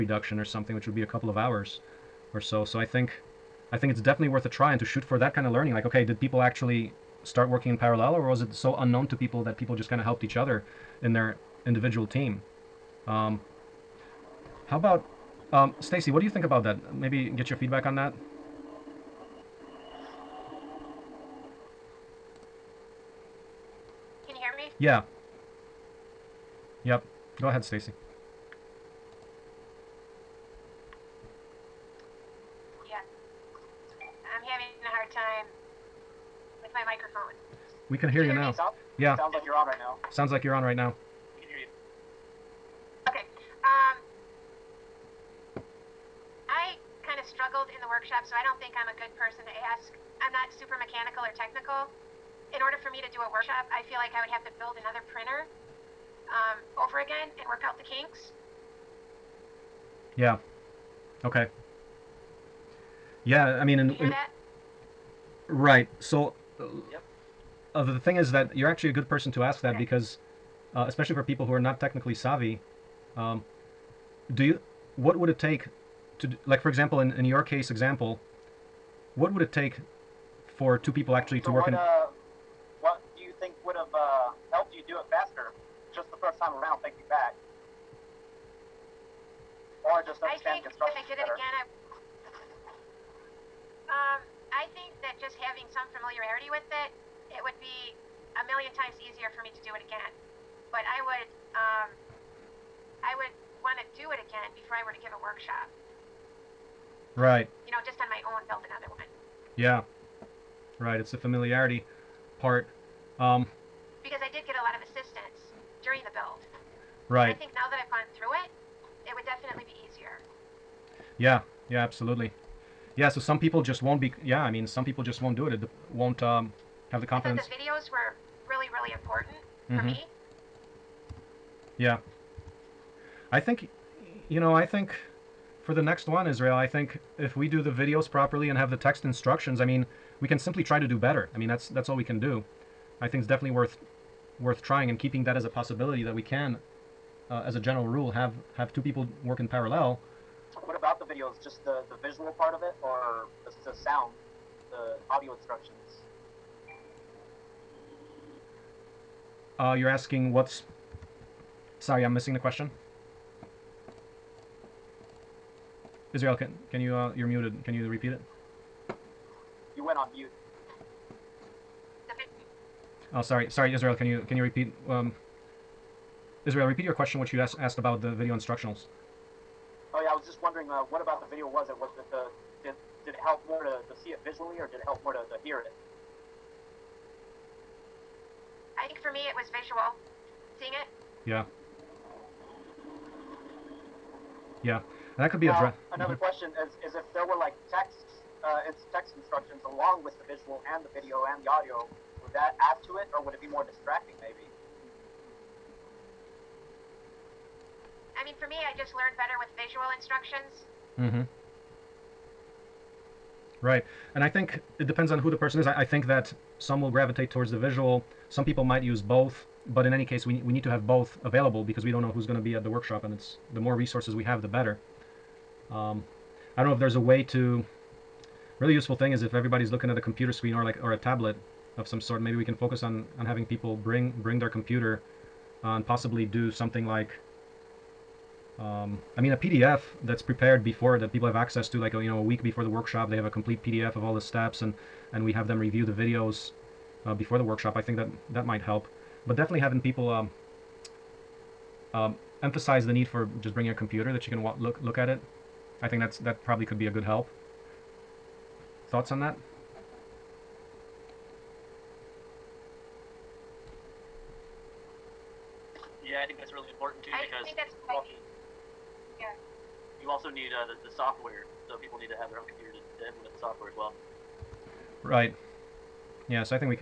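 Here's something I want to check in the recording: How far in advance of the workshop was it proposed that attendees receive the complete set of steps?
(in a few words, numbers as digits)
a week.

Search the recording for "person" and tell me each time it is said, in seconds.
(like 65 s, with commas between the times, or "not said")
49 s, 69 s, 215 s.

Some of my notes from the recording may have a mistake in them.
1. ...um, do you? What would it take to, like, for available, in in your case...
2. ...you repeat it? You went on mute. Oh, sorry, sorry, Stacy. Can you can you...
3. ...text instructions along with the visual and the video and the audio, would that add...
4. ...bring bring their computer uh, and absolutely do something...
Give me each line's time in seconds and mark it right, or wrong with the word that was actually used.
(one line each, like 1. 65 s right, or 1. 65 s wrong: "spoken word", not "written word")
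1. 73 s wrong: "example", not "available"
2. 167 s wrong: "Israel", not "Stacy"
3. 198 s right
4. 233 s wrong: "possibly", not "absolutely".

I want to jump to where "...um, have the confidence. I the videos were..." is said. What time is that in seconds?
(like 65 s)
126 s.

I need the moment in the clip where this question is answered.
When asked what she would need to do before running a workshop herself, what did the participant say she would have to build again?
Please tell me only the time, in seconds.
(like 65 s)
54 s.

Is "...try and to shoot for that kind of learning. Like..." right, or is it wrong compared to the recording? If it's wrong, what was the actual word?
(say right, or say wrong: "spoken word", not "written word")
right.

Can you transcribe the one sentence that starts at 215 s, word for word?
I, I, think that some will gravitate towards the visual.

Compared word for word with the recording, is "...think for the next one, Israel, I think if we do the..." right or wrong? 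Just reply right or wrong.
right.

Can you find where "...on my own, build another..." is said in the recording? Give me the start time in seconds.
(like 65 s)
108 s.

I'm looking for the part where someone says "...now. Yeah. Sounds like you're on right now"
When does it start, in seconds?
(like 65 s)
38 s.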